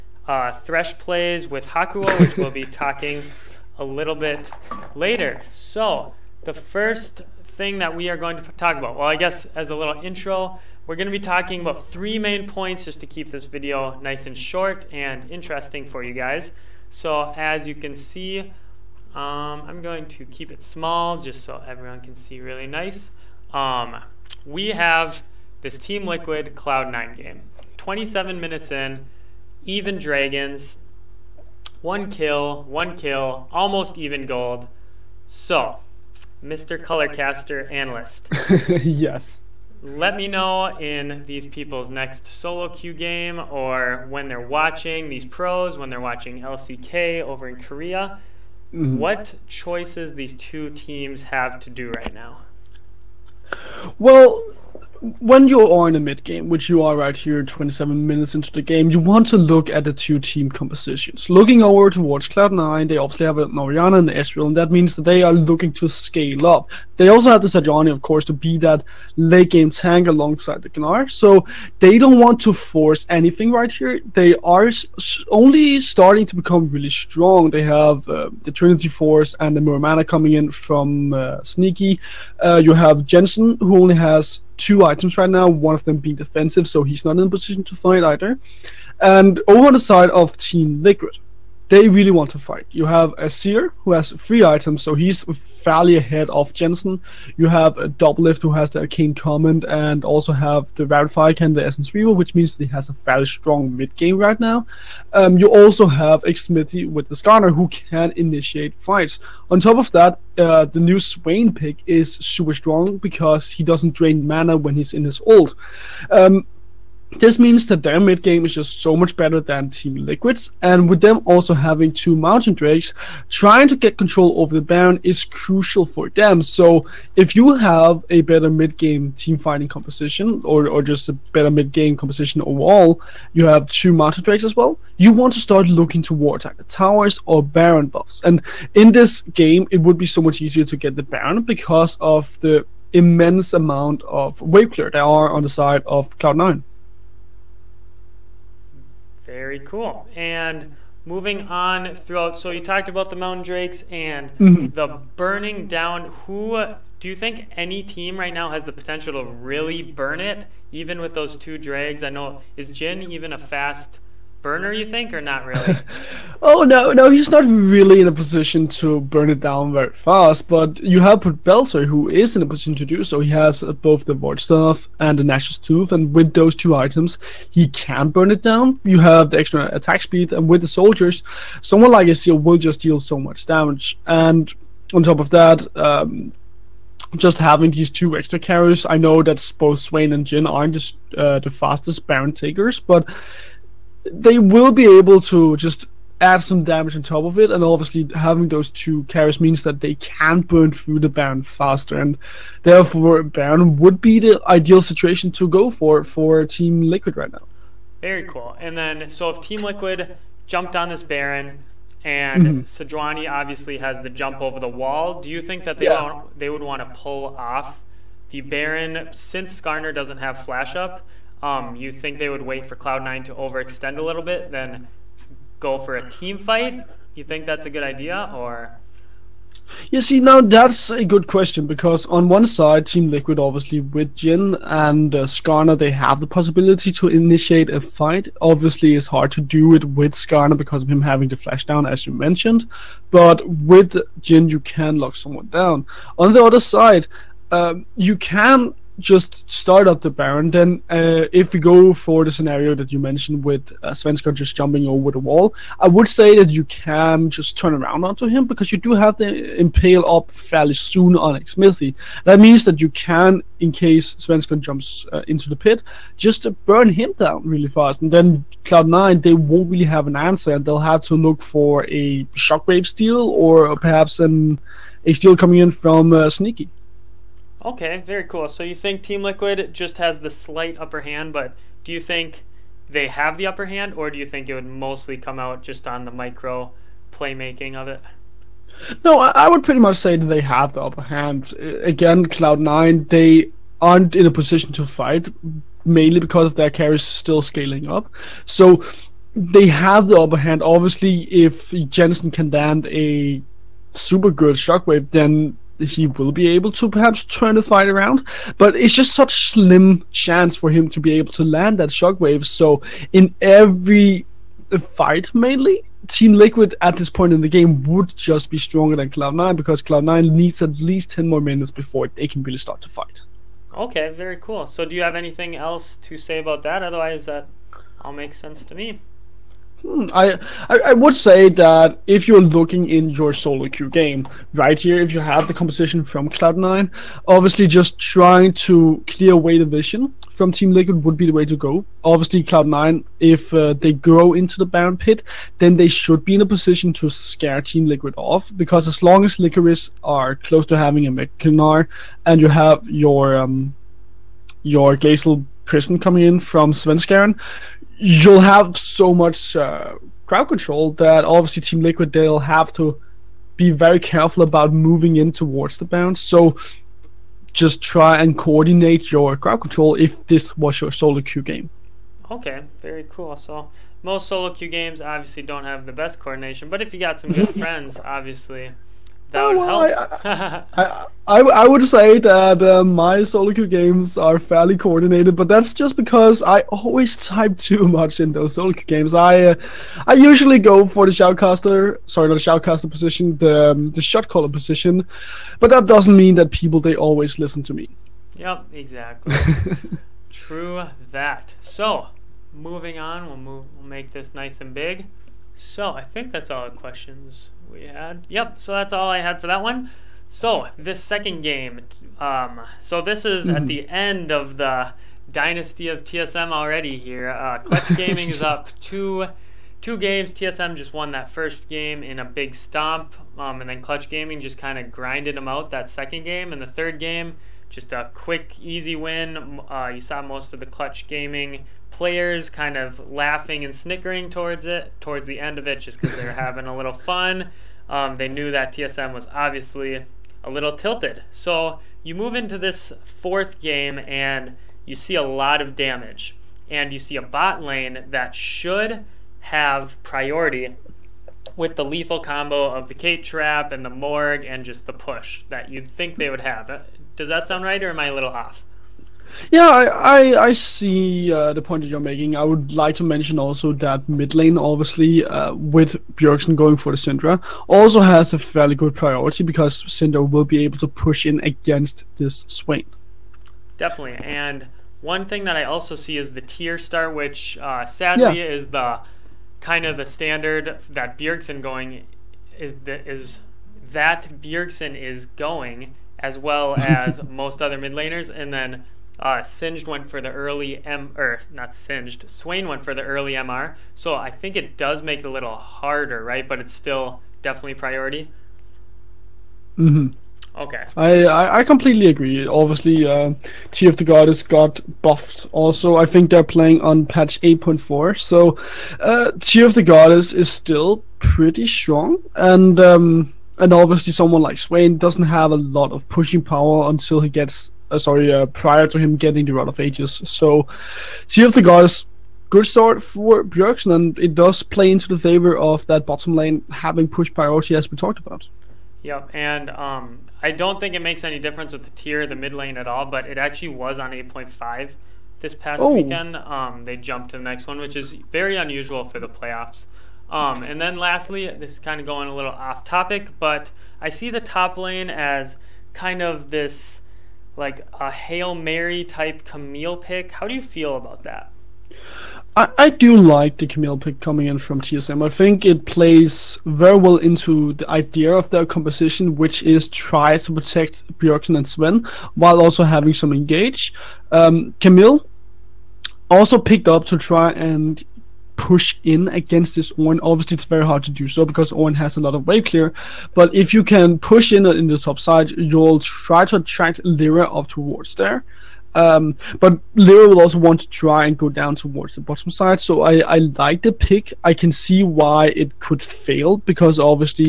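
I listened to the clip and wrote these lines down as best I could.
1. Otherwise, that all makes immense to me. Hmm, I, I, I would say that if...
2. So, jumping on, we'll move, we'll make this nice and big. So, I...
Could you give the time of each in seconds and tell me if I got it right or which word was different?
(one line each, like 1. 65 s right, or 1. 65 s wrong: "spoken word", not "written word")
1. 326 s wrong: "sense", not "immense"
2. 401 s wrong: "moving", not "jumping".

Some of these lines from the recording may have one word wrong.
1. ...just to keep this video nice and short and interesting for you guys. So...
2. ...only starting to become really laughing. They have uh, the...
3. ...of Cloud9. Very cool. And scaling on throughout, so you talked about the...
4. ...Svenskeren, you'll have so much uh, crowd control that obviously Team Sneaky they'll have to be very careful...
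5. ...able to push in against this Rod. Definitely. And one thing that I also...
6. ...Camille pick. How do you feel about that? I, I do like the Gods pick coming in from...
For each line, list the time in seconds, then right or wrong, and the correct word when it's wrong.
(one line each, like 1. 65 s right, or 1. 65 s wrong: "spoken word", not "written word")
1. 12 s right
2. 75 s wrong: "strong", not "laughing"
3. 145 s wrong: "moving", not "scaling"
4. 356 s wrong: "Liquid", not "Sneaky"
5. 470 s wrong: "Swain", not "Rod"
6. 549 s wrong: "Camille", not "Gods".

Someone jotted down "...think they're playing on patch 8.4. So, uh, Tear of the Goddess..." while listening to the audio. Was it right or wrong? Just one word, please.
right.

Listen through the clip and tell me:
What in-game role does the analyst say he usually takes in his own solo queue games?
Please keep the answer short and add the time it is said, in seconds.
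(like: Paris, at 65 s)
shot caller, at 394 s.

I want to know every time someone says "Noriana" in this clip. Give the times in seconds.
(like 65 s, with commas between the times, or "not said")
63 s.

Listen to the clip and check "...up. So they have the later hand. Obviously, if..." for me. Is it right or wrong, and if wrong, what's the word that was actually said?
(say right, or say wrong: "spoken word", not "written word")
wrong: "upper", not "later".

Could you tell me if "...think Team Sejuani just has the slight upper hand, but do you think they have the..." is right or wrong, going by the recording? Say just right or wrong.
wrong.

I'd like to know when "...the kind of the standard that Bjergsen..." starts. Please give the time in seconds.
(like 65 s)
478 s.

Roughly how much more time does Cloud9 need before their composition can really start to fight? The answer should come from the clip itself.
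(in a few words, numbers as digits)
ten more minutes.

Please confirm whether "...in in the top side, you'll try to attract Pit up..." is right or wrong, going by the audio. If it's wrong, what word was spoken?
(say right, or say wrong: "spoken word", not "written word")
wrong: "Lira", not "Pit".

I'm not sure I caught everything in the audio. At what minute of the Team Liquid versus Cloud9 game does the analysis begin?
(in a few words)
27 minutes.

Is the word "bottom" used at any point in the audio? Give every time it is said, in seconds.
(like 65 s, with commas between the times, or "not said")
526 s, 582 s.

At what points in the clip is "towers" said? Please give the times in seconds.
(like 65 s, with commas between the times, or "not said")
136 s.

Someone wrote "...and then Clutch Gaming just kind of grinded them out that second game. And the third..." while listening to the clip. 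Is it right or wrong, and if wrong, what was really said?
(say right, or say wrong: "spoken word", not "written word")
right.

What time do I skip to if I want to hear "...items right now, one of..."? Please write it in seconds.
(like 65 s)
84 s.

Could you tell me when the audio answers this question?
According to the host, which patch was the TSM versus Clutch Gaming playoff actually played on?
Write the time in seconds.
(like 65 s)
534 s.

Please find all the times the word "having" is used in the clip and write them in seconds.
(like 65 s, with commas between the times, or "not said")
121 s, 187 s, 198 s, 241 s, 350 s, 436 s, 526 s, 562 s.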